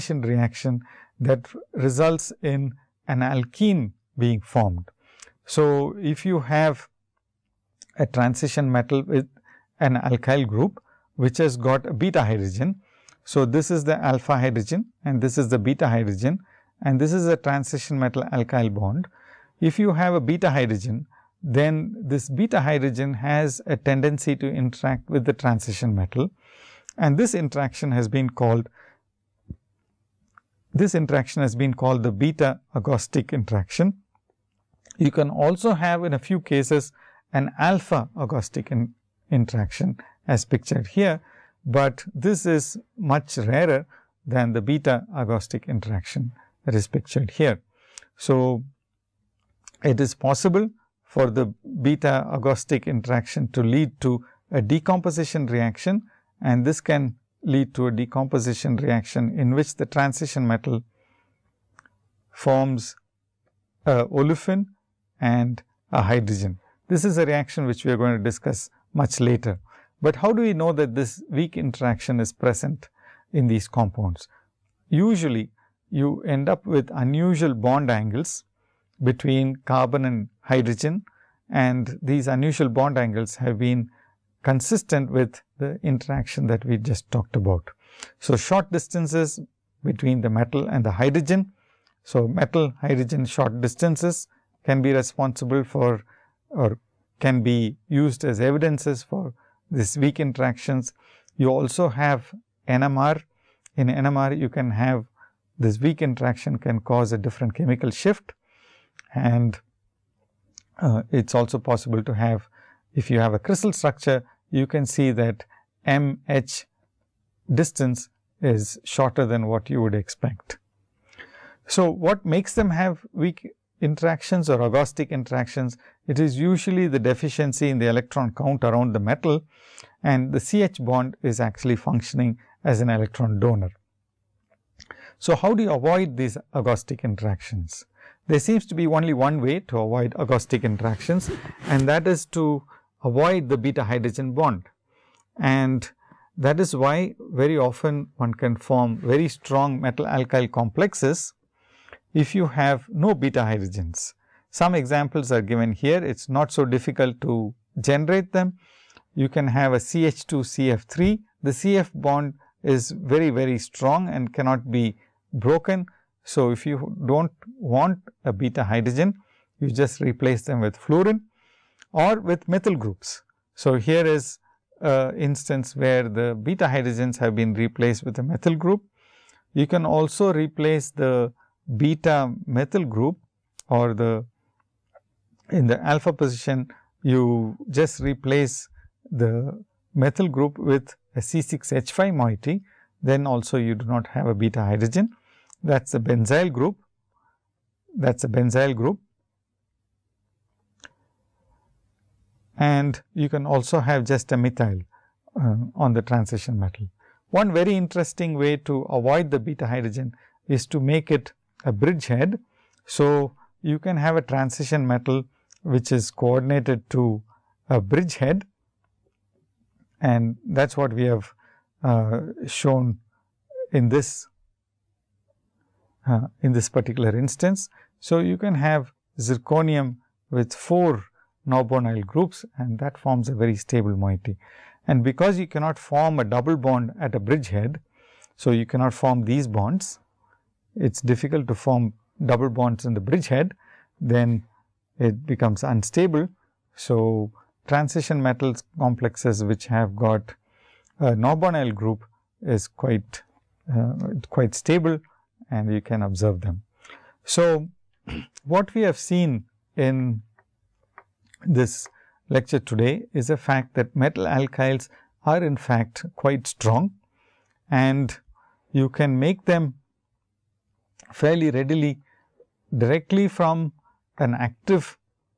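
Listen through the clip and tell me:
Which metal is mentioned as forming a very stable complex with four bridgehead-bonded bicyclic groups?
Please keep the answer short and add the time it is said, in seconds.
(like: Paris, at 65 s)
zirconium, at 229 s.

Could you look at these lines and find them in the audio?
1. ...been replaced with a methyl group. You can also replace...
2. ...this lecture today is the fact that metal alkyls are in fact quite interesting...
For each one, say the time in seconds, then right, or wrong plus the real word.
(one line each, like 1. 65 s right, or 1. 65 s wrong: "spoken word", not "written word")
1. 177 s right
2. 261 s wrong: "strong", not "interesting".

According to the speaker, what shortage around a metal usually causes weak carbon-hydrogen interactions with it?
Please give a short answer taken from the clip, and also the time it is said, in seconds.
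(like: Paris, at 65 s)
electron count, at 127 s.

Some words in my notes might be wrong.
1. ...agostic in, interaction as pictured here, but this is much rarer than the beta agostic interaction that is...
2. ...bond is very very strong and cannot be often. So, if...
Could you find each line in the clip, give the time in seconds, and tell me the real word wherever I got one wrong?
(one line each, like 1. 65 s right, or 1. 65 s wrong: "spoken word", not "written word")
1. 38 s right
2. 161 s wrong: "broken", not "often".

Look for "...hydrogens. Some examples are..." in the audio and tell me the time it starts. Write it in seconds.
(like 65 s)
153 s.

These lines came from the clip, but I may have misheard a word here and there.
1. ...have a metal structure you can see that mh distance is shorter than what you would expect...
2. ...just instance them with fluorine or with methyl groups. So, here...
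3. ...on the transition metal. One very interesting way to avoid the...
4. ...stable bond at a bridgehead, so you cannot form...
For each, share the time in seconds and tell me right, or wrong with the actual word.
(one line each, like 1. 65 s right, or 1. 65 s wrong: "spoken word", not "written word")
1. 113 s wrong: "crystal", not "metal"
2. 169 s wrong: "replace", not "instance"
3. 205 s right
4. 236 s wrong: "double", not "stable".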